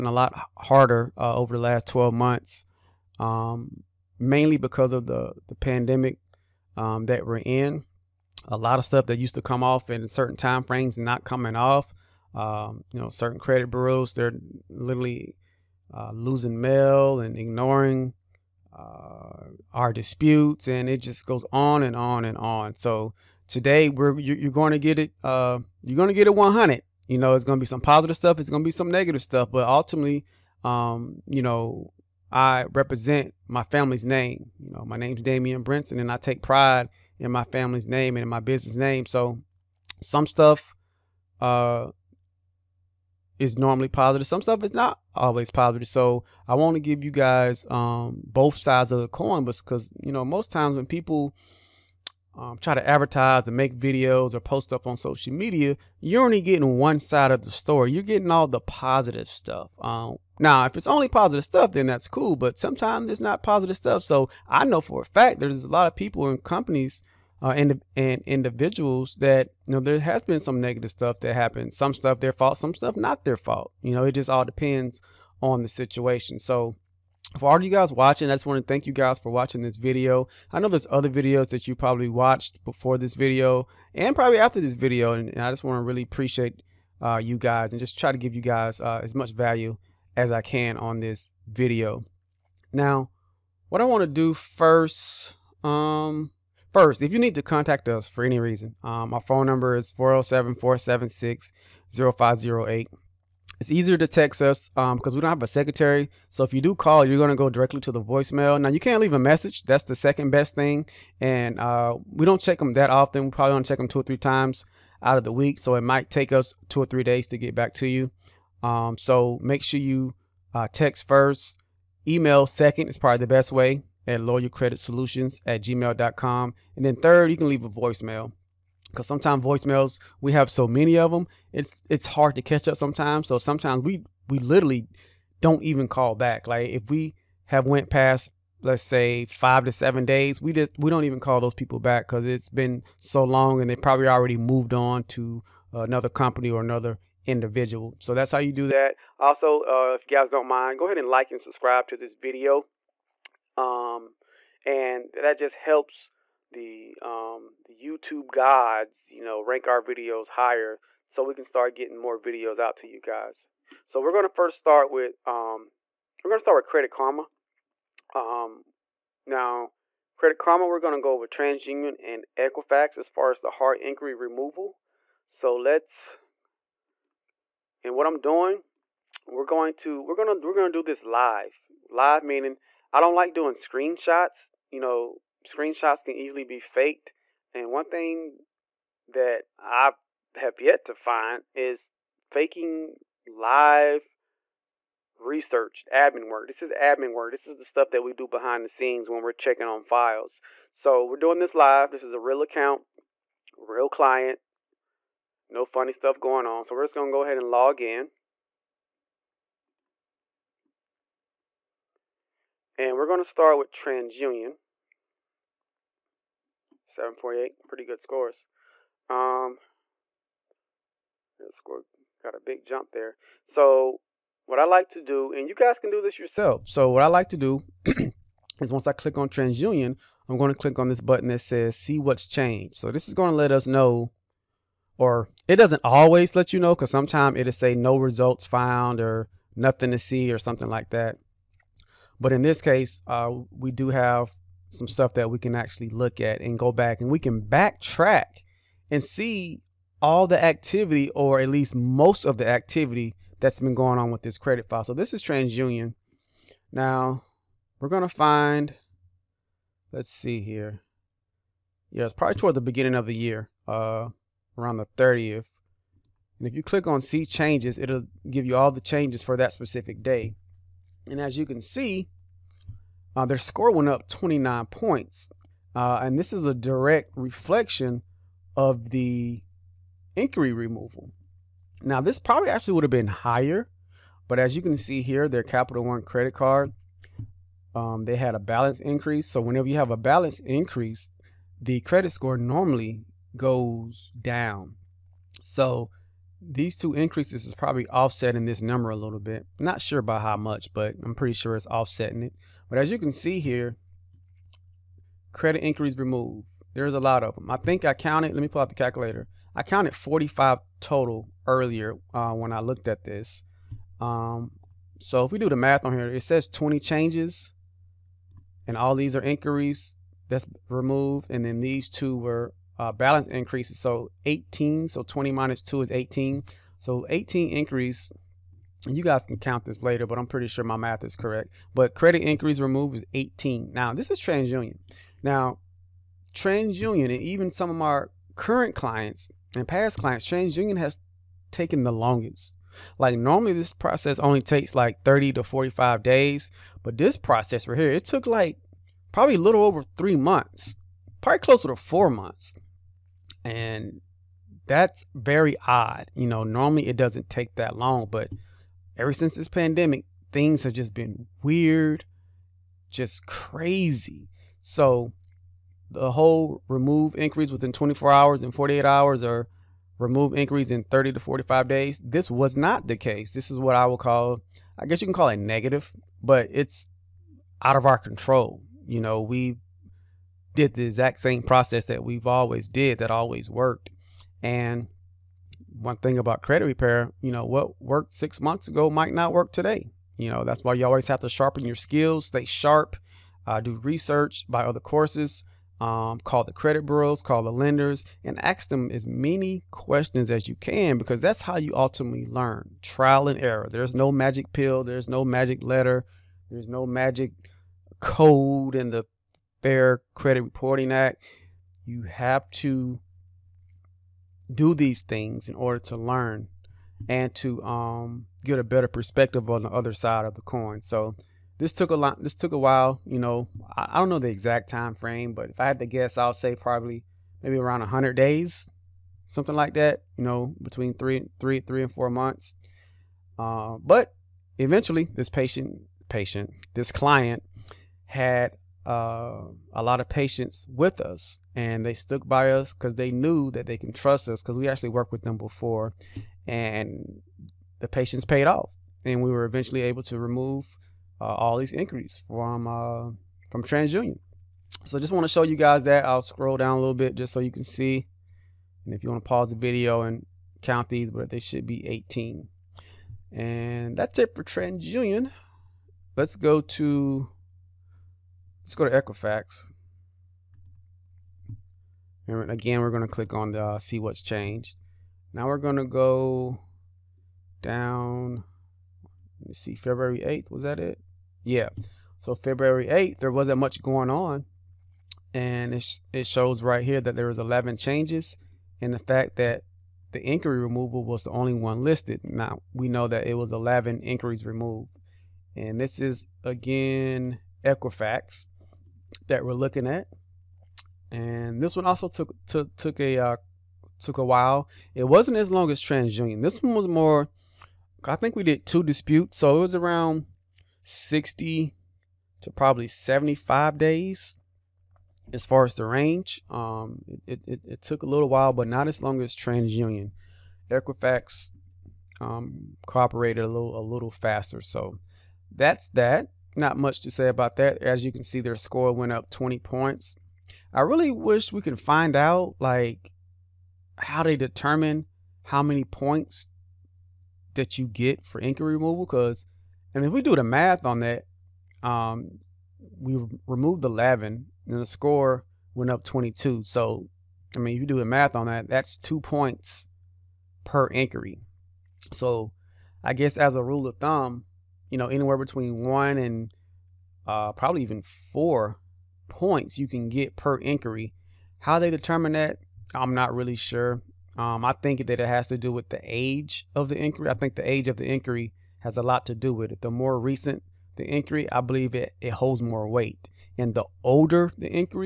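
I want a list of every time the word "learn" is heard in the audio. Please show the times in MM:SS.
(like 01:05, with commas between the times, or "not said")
06:42, 06:55.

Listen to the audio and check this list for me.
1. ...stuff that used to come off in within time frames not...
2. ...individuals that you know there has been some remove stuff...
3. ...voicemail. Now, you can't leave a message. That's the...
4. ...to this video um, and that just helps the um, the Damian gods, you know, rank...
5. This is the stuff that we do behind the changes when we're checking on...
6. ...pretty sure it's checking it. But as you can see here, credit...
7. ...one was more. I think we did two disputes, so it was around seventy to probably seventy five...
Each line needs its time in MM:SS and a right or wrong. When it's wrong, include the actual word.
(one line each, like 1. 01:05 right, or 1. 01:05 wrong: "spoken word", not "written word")
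1. 00:08 wrong: "certain", not "within"
2. 01:08 wrong: "negative", not "remove"
3. 01:48 right
4. 02:31 wrong: "YouTube", not "Damian"
5. 03:17 wrong: "scenes", not "changes"
6. 05:01 wrong: "offsetting", not "checking"
7. 08:26 wrong: "sixty", not "seventy".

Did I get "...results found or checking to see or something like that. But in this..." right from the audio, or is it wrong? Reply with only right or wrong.
wrong.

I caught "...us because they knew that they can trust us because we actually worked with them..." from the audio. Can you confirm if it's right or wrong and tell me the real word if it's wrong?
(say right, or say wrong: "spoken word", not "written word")
right.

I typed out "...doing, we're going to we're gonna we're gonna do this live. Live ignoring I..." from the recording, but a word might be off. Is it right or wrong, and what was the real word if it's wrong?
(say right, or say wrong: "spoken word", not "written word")
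wrong: "meaning", not "ignoring".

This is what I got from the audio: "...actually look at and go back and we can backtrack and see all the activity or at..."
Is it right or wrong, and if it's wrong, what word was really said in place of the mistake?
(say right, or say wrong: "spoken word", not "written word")
right.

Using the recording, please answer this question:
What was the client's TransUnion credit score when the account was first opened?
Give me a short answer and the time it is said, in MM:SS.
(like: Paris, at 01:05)
748, at 03:36.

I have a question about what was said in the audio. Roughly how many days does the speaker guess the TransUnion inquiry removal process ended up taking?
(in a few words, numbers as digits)
100 days.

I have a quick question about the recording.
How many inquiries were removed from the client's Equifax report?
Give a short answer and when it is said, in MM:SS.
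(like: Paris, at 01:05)
11, at 08:07.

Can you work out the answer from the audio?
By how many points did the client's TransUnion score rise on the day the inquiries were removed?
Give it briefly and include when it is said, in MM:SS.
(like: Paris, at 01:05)
29, at 04:34.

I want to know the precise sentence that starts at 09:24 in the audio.
Um, I think that it has to do with the age of the inquiry.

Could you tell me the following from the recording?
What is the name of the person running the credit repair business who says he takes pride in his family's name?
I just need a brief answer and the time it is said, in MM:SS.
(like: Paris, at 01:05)
Damian Brinson, at 00:35.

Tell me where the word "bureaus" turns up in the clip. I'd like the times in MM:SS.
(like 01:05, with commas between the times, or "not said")
00:13, 06:36.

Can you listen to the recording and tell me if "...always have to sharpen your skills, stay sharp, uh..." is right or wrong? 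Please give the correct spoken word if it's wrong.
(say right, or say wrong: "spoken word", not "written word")
right.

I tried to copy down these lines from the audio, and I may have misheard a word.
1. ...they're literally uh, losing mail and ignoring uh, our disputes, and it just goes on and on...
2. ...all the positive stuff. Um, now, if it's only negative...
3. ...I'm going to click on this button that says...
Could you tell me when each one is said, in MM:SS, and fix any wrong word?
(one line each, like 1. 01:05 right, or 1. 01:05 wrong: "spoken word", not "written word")
1. 00:14 right
2. 00:58 wrong: "positive", not "negative"
3. 03:50 right.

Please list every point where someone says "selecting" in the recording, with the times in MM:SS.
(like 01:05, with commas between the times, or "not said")
not said.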